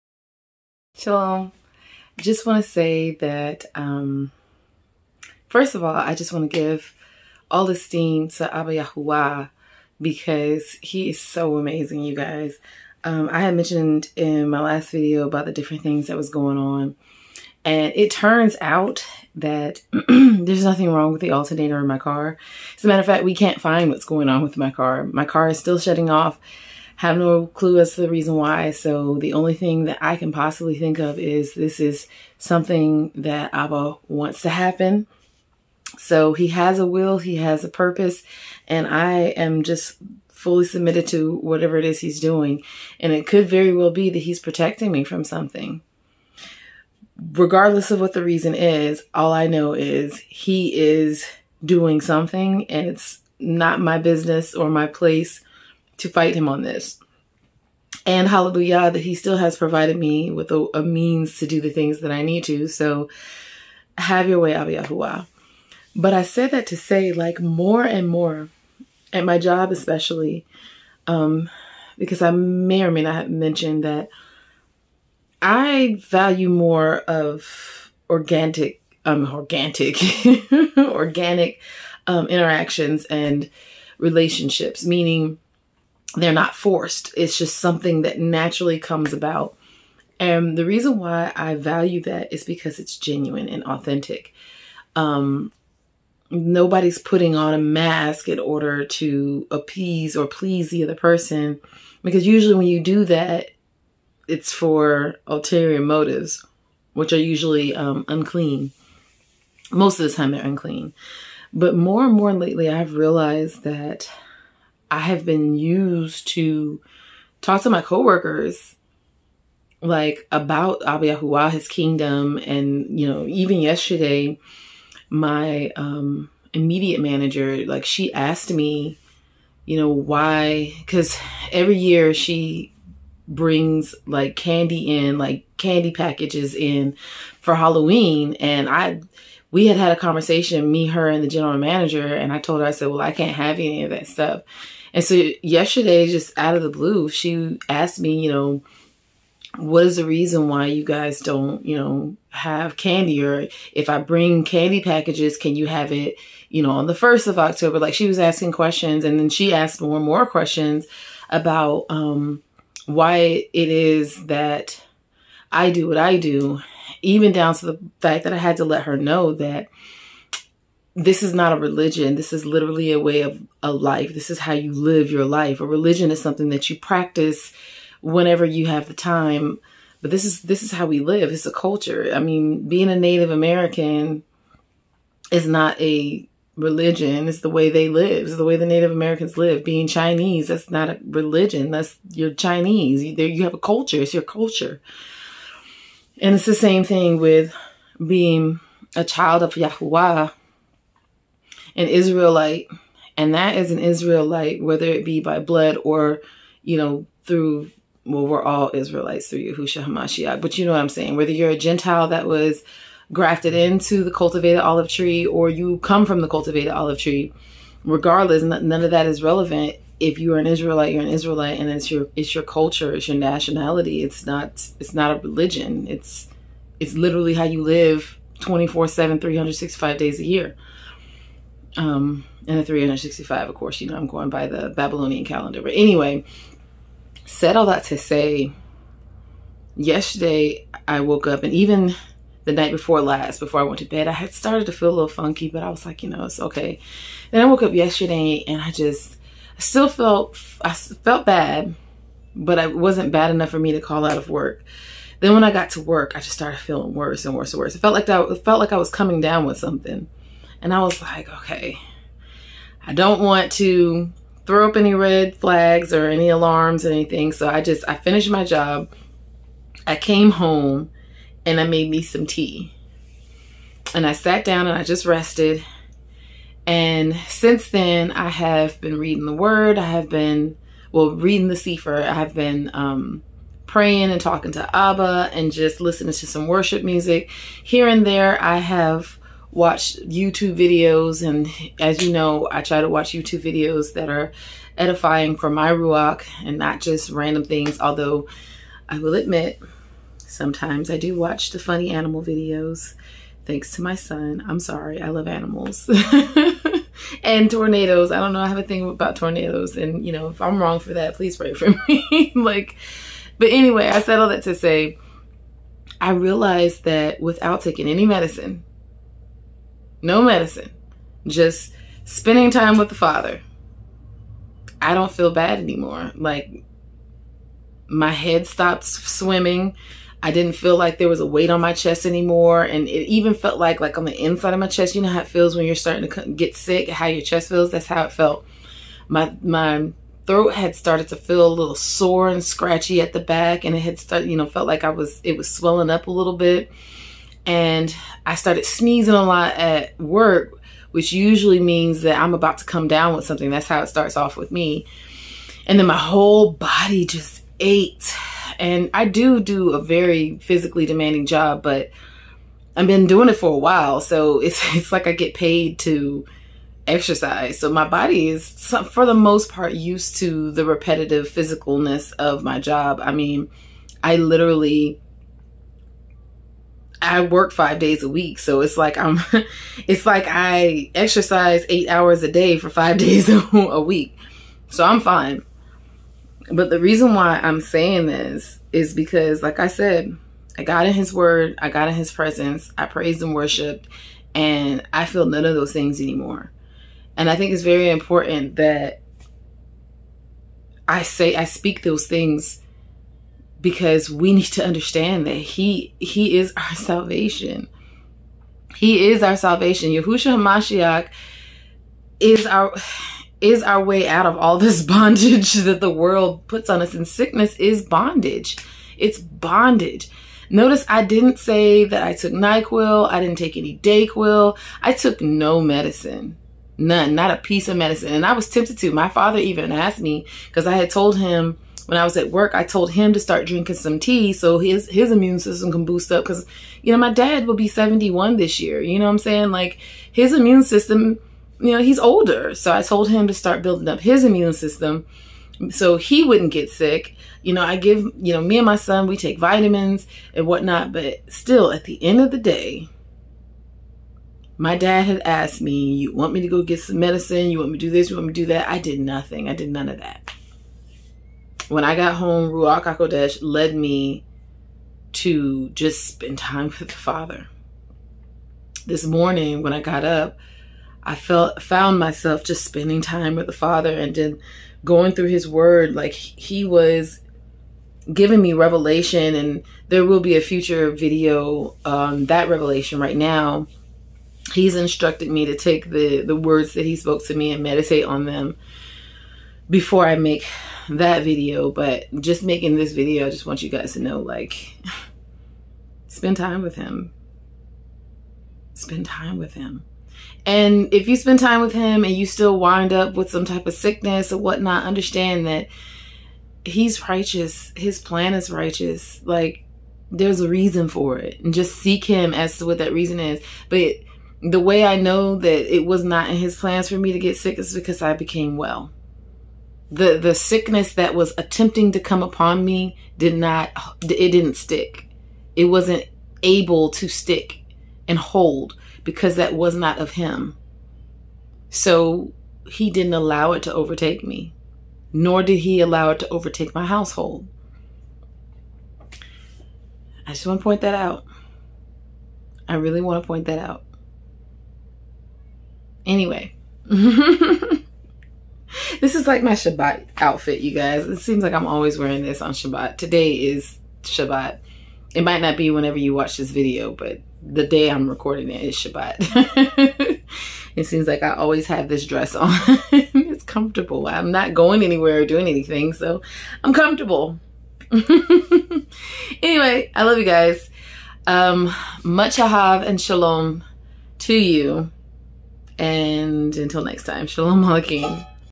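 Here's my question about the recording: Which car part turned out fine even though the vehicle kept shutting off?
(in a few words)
alternator.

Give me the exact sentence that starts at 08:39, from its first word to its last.
The the sickness that was attempting to come upon me did not it didn't stick.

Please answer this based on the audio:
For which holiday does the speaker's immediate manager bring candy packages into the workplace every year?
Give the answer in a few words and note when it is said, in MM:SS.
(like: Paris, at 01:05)
Halloween, at 02:17.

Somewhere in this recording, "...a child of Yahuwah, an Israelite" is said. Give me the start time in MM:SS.
03:18.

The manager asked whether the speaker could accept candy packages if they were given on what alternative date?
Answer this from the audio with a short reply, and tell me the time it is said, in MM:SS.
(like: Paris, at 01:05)
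October 1, at 02:36.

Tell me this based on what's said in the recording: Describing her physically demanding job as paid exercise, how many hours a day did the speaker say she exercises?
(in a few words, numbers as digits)
8.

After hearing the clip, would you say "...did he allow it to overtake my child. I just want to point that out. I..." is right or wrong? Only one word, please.
wrong.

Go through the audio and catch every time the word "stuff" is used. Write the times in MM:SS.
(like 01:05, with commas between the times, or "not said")
02:24.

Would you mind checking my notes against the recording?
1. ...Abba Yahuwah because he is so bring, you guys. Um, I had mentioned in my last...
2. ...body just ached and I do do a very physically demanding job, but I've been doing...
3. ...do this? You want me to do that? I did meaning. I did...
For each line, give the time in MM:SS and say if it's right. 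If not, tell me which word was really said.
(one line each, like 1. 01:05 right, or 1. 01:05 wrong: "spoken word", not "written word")
1. 00:08 wrong: "amazing", not "bring"
2. 05:56 right
3. 07:37 wrong: "nothing", not "meaning".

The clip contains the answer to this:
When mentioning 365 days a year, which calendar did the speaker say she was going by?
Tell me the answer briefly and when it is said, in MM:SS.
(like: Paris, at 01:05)
Babylonian calendar, at 03:54.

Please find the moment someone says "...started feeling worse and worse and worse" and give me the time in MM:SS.
04:16.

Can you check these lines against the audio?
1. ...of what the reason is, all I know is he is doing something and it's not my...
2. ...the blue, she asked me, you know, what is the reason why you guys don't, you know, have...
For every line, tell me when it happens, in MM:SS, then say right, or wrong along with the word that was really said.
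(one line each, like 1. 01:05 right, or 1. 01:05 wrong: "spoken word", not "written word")
1. 00:47 right
2. 02:26 right.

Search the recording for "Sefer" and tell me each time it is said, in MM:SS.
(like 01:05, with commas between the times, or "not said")
04:41.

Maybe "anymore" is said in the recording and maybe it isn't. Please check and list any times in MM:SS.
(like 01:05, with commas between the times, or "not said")
05:25, 05:32, 06:36.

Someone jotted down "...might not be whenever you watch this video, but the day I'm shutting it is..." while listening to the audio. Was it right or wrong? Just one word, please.
wrong.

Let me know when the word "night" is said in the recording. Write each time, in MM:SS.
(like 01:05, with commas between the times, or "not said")
04:02.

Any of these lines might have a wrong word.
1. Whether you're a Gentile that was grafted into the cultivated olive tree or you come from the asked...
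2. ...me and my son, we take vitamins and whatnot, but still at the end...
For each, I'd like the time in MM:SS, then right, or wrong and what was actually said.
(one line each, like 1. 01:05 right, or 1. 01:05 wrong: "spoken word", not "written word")
1. 03:31 wrong: "cultivated", not "asked"
2. 07:28 right.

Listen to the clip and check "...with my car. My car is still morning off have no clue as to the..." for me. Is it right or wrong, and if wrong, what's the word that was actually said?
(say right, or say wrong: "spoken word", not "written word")
wrong: "shutting", not "morning".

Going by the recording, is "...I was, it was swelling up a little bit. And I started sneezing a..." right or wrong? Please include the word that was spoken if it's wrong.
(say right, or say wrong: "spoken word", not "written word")
right.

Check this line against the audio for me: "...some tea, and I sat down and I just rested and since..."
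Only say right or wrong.
right.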